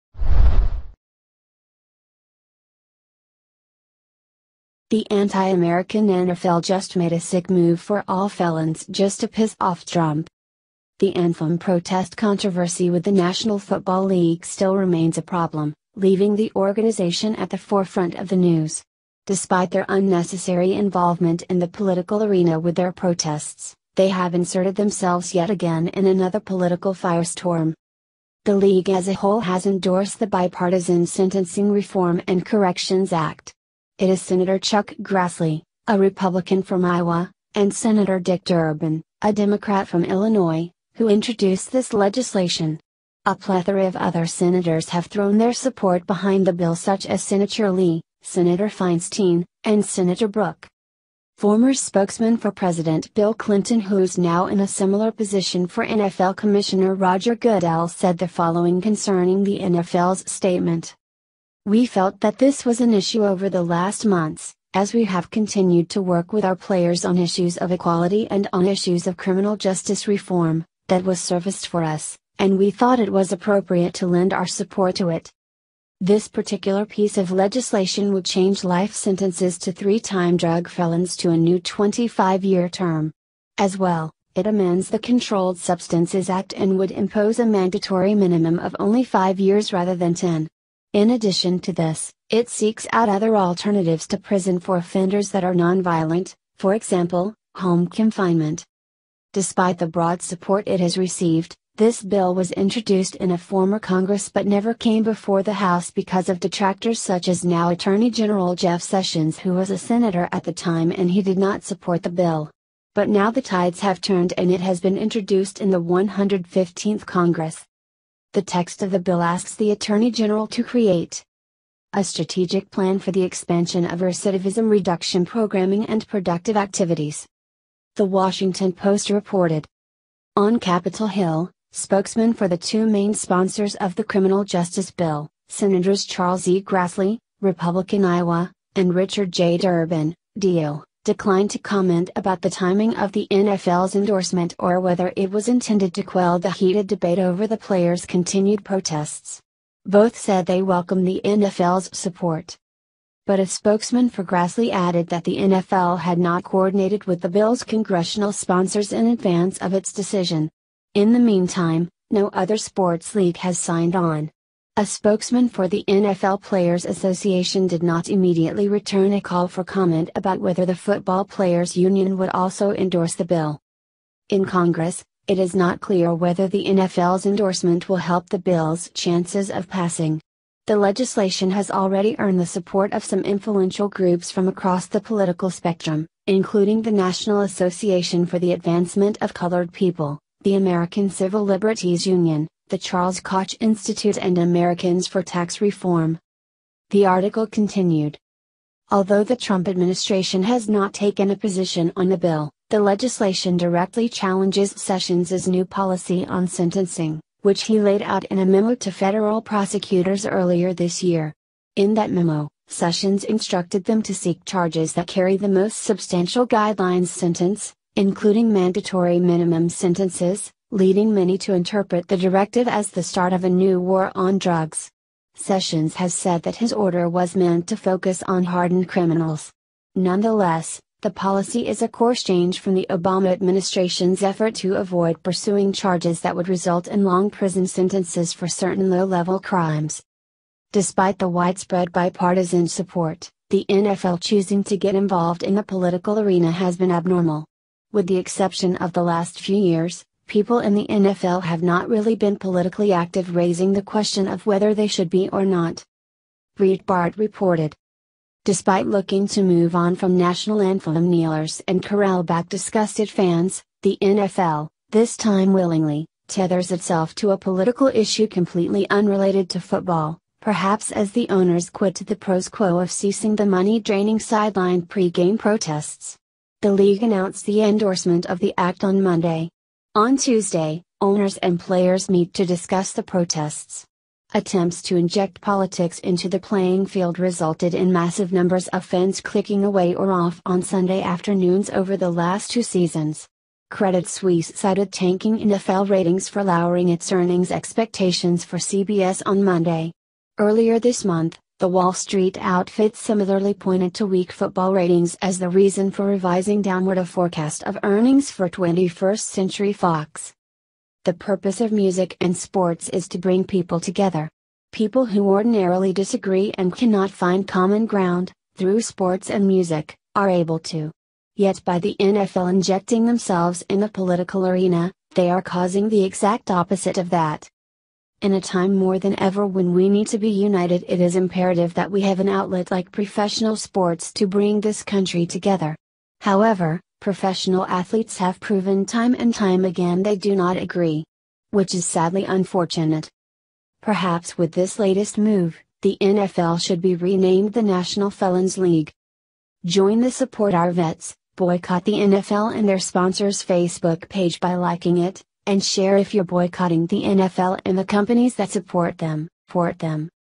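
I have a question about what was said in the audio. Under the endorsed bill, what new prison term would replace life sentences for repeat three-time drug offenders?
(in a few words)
25 year term.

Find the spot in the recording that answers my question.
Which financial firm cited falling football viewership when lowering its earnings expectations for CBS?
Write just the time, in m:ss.
4:53.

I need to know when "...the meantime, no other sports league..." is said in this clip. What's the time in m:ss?
2:41.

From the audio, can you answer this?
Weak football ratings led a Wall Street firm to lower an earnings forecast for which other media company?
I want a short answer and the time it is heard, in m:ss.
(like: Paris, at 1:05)
21st Century Fox, at 5:08.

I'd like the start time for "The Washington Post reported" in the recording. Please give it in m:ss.
2:07.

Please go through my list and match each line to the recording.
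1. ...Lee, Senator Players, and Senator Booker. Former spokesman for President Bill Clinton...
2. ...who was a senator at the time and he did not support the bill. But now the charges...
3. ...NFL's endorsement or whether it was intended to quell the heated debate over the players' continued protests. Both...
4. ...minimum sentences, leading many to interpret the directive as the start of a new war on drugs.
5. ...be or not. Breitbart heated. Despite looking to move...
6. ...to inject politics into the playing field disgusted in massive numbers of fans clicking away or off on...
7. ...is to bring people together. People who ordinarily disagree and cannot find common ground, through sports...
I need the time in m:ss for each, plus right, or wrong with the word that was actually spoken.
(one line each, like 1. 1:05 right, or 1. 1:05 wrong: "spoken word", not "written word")
1. 0:47 wrong: "Feinstein", not "Players"
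2. 1:49 wrong: "tides", not "charges"
3. 2:23 right
4. 3:39 right
5. 4:15 wrong: "reported", not "heated"
6. 4:44 wrong: "resulted", not "disgusted"
7. 5:12 right.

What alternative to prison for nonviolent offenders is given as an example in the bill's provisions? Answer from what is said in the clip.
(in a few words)
home confinement.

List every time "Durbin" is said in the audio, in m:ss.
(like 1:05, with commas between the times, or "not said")
0:38, 2:19.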